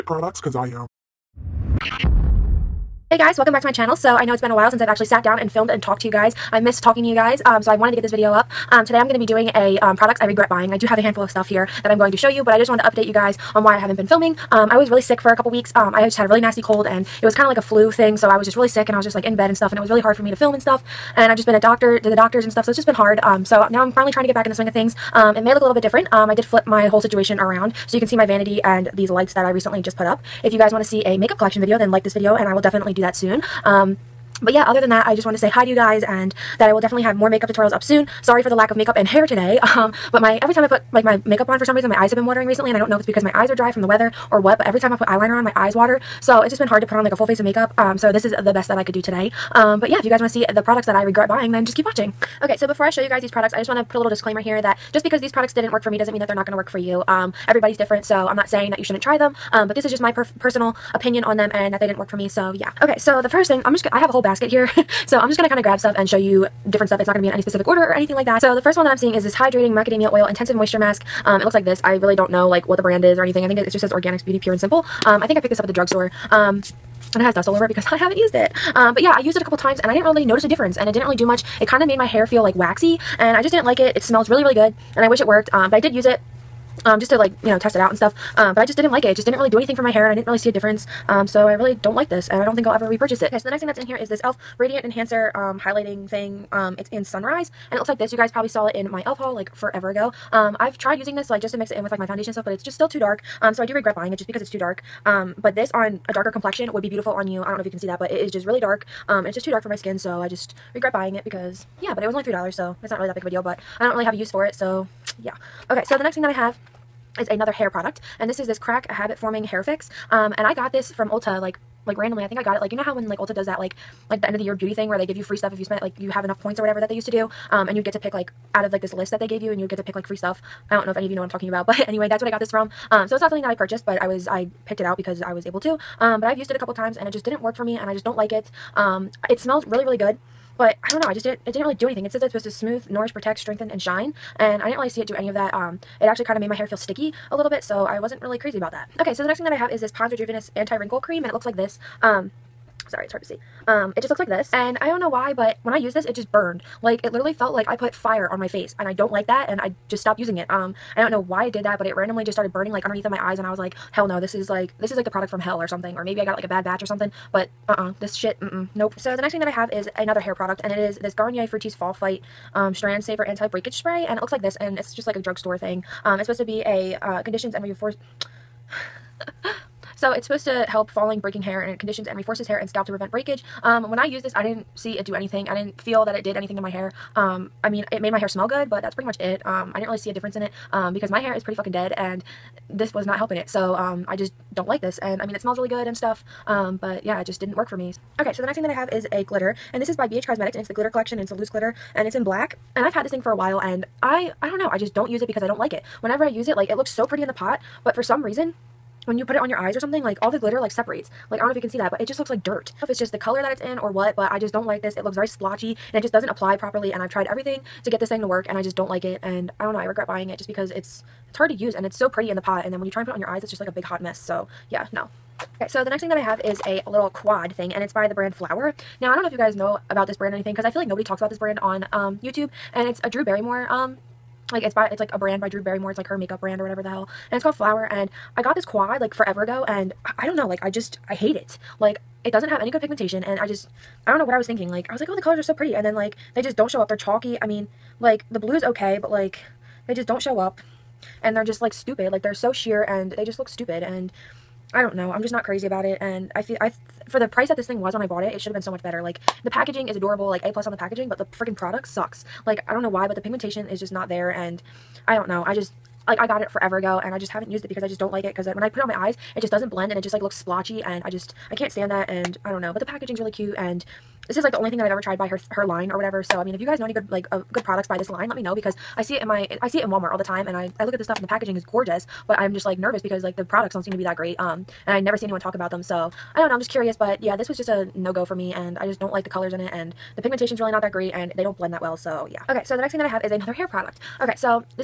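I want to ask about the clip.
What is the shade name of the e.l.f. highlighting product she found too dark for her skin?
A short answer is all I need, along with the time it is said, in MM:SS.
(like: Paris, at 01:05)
Sunrise, at 01:37.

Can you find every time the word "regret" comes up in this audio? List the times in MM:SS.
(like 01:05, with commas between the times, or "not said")
00:10, 00:51, 01:43, 01:50, 03:39.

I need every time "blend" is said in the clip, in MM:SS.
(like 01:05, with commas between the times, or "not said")
04:29, 04:51.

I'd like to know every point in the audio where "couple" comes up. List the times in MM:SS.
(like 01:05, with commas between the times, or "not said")
00:15, 01:19, 02:16.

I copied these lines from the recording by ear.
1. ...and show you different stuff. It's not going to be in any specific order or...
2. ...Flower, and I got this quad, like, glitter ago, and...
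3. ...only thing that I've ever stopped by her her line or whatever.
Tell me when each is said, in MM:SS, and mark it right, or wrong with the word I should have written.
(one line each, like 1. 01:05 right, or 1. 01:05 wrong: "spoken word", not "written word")
1. 01:05 right
2. 03:57 wrong: "forever", not "glitter"
3. 04:34 wrong: "tried", not "stopped".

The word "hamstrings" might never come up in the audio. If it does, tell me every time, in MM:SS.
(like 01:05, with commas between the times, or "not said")
not said.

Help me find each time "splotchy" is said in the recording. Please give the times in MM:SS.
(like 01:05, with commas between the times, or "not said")
03:35, 04:30.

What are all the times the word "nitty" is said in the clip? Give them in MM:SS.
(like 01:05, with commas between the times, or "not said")
not said.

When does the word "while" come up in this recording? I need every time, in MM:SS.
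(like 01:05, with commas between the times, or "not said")
00:04, 03:23.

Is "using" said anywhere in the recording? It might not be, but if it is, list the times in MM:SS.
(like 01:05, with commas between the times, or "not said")
01:40, 02:40.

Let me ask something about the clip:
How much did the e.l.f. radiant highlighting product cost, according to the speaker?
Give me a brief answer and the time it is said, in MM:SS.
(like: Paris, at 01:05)
$3, at 01:52.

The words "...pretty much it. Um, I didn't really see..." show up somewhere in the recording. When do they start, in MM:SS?
03:08.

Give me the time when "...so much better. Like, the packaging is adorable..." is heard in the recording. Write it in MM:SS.
04:18.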